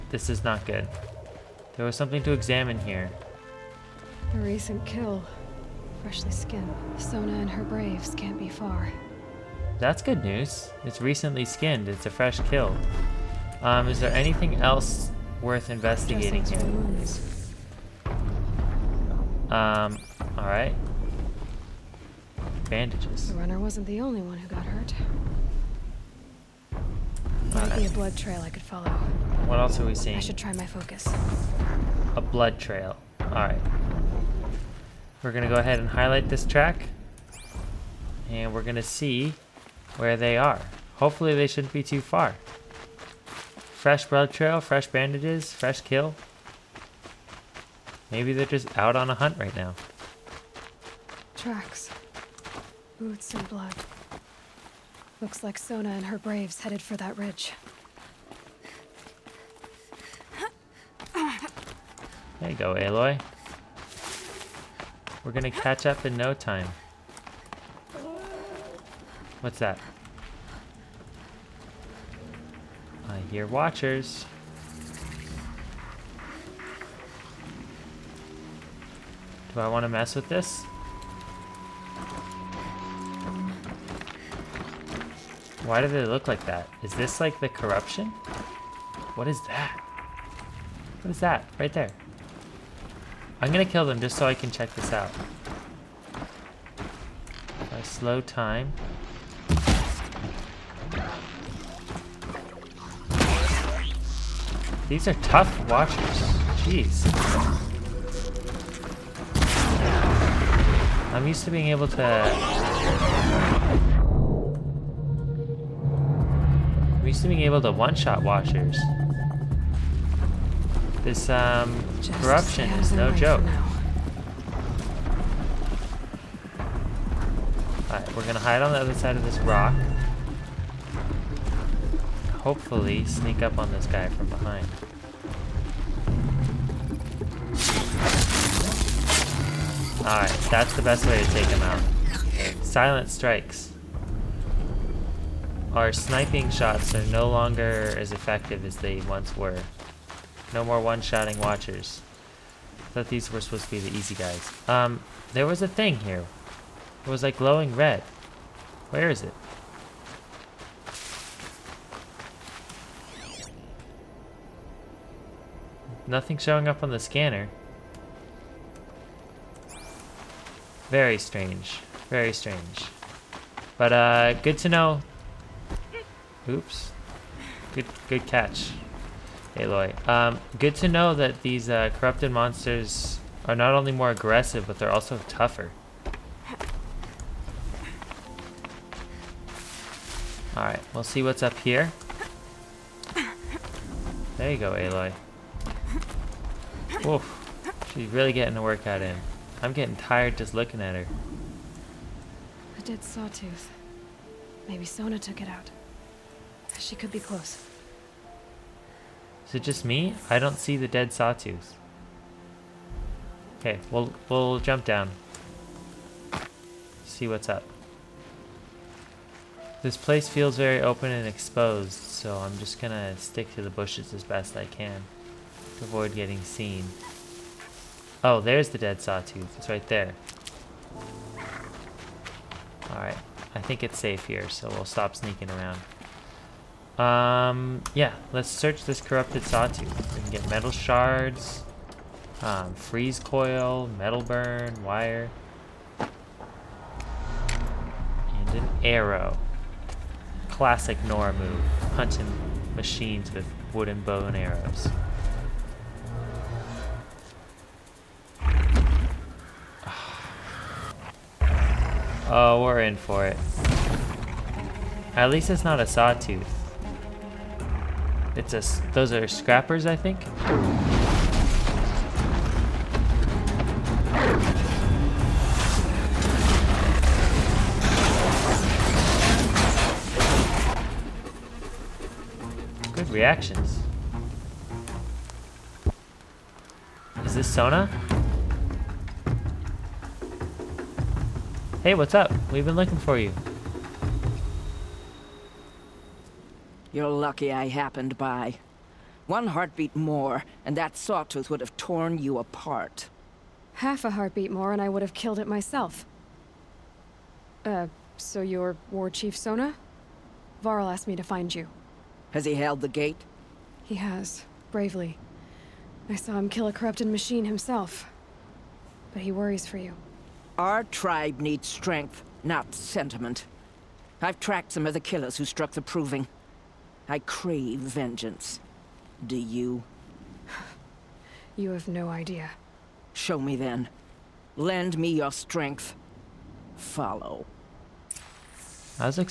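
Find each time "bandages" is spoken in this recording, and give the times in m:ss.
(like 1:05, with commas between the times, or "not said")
0:22, 0:44.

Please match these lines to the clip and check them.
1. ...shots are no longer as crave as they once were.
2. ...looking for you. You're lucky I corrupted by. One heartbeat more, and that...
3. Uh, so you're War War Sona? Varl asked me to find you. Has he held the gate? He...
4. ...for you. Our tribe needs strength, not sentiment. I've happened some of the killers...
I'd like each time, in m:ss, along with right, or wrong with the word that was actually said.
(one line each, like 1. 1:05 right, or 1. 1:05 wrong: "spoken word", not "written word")
1. 2:26 wrong: "effective", not "crave"
2. 4:52 wrong: "happened", not "corrupted"
3. 5:07 wrong: "Chief", not "War"
4. 5:19 wrong: "tracked", not "happened".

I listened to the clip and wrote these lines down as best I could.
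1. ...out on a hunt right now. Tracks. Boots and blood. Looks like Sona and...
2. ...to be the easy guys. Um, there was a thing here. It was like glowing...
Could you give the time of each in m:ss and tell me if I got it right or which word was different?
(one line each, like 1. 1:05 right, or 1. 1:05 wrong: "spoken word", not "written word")
1. 0:48 right
2. 2:33 right.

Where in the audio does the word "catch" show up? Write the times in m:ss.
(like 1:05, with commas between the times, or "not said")
1:05, 2:58.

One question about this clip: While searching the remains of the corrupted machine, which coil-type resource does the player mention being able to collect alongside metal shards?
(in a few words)
freeze coil.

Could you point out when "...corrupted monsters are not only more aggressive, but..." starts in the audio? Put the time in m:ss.
3:01.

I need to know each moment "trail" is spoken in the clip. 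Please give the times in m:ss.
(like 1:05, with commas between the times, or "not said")
0:28, 0:32, 0:44.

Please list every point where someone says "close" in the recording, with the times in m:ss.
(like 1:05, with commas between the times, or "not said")
3:27.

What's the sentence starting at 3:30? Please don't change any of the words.
I don't see the dead sawtooth.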